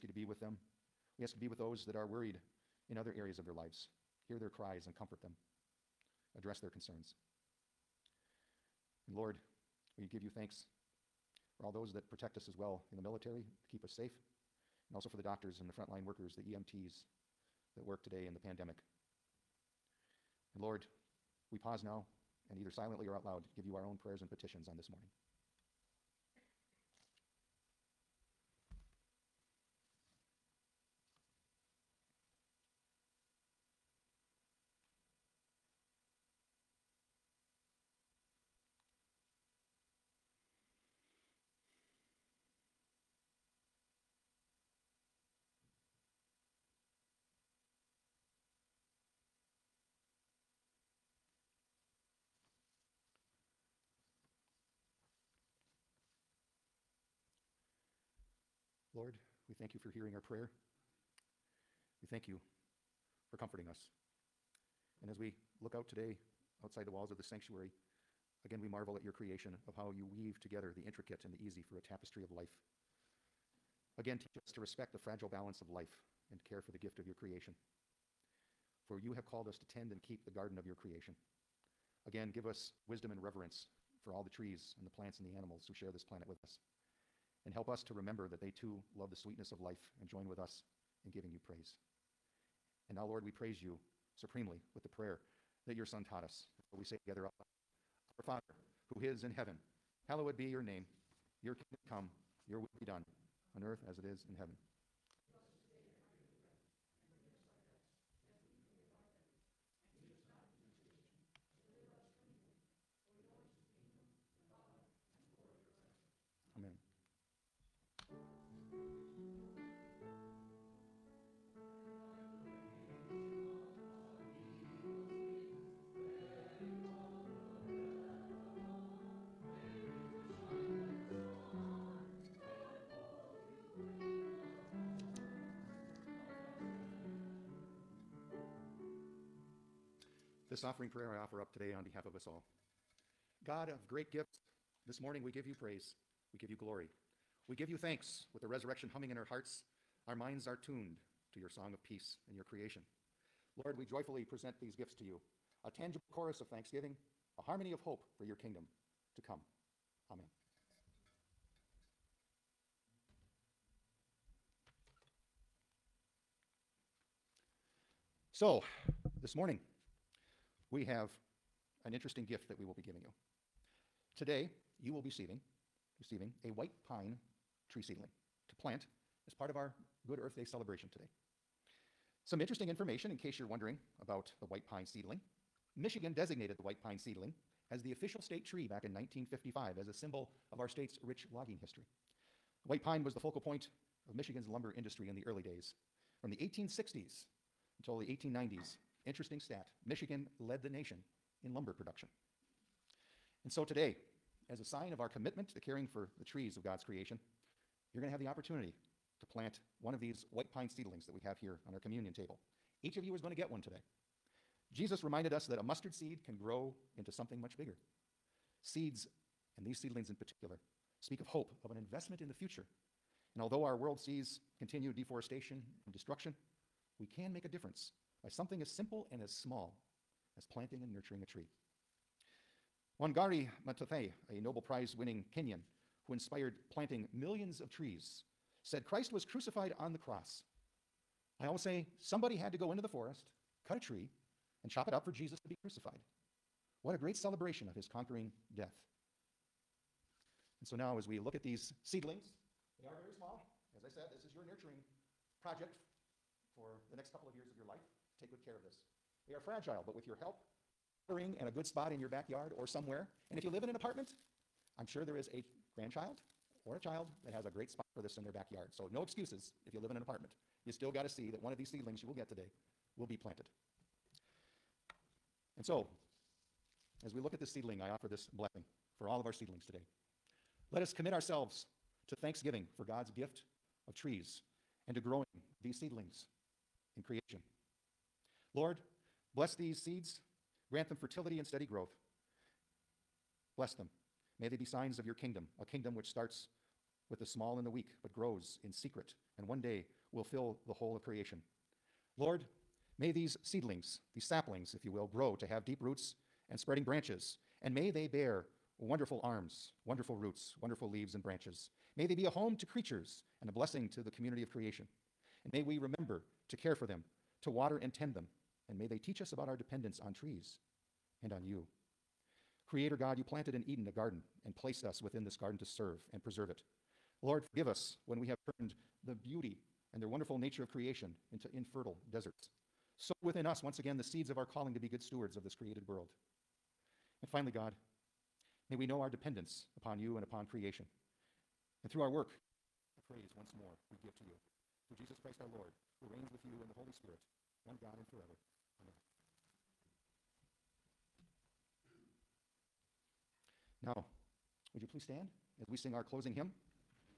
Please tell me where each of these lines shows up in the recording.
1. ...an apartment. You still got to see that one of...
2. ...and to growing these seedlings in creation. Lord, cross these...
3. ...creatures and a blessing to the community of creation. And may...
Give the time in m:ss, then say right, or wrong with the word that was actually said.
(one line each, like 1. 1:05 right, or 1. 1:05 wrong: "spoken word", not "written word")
1. 4:29 right
2. 4:44 wrong: "bless", not "cross"
3. 5:12 right.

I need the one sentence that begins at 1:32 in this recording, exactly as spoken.
And now, Lord, we praise you supremely with the prayer that your Son taught us.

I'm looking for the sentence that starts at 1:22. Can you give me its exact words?
Again, give us wisdom and reverence for all the trees and the plants and the animals who share this planet with us.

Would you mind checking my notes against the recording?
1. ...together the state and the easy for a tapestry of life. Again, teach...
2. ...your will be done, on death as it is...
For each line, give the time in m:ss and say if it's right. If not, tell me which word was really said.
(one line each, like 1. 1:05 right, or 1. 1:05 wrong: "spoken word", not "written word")
1. 1:10 wrong: "intricate", not "state"
2. 1:42 wrong: "earth", not "death".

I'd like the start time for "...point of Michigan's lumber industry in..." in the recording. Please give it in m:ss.
3:13.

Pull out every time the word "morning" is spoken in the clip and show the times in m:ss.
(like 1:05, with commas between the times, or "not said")
0:24, 2:24, 2:49.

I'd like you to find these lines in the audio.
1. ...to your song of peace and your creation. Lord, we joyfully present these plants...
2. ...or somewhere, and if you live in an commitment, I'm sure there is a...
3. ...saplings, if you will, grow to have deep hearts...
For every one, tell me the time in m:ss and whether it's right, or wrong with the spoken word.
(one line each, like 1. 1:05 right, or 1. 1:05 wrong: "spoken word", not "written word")
1. 2:31 wrong: "gifts", not "plants"
2. 4:22 wrong: "apartment", not "commitment"
3. 5:04 wrong: "roots", not "hearts".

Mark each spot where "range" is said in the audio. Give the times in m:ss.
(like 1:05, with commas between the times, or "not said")
not said.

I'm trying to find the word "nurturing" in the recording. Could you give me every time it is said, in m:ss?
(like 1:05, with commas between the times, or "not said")
3:50, 4:14.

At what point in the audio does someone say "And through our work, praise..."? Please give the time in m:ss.
5:41.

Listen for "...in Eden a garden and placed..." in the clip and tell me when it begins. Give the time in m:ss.
5:23.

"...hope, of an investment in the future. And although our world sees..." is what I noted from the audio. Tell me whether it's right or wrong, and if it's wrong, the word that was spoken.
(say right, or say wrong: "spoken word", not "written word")
right.